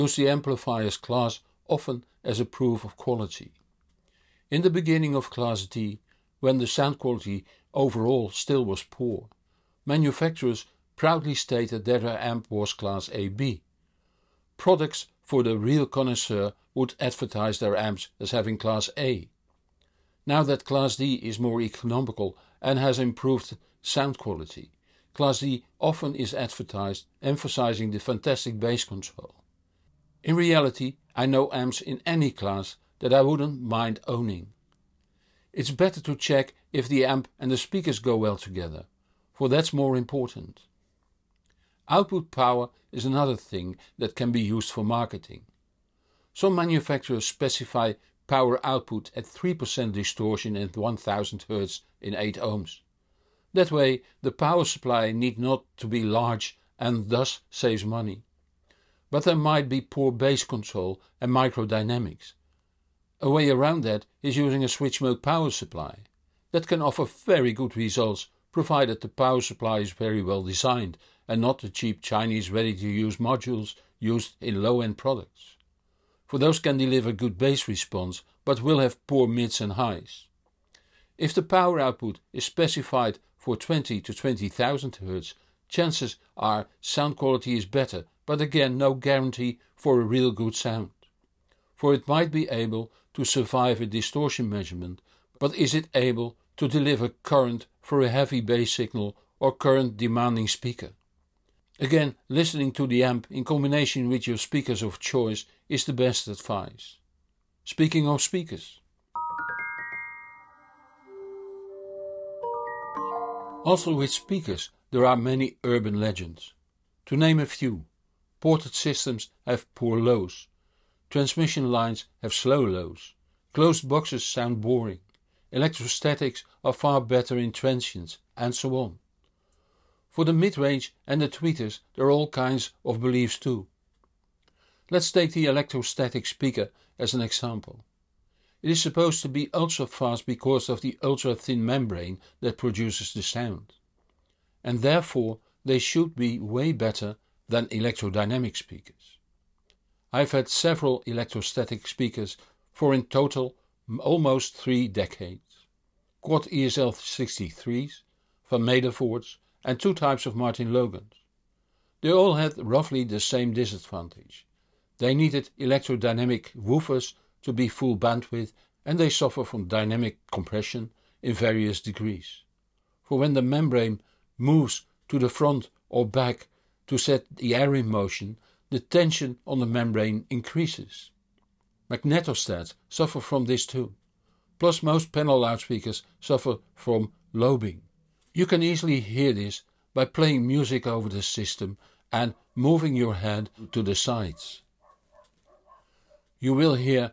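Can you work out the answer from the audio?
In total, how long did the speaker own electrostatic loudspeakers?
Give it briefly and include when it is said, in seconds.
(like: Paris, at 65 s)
almost three decades, at 154 s.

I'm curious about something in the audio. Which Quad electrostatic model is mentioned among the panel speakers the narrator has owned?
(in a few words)
ESL 63.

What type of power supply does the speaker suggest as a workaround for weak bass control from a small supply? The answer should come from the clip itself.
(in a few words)
switch mode power supply.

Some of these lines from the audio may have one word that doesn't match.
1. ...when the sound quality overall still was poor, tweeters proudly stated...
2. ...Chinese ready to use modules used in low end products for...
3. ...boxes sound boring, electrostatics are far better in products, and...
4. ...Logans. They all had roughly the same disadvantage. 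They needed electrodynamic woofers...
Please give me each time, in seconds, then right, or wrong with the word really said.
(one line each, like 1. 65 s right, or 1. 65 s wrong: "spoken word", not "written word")
1. 6 s wrong: "manufacturers", not "tweeters"
2. 72 s right
3. 123 s wrong: "transients", not "products"
4. 160 s right.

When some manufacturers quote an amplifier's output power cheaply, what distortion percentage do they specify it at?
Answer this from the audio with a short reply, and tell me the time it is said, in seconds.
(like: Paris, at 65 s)
3%, at 49 s.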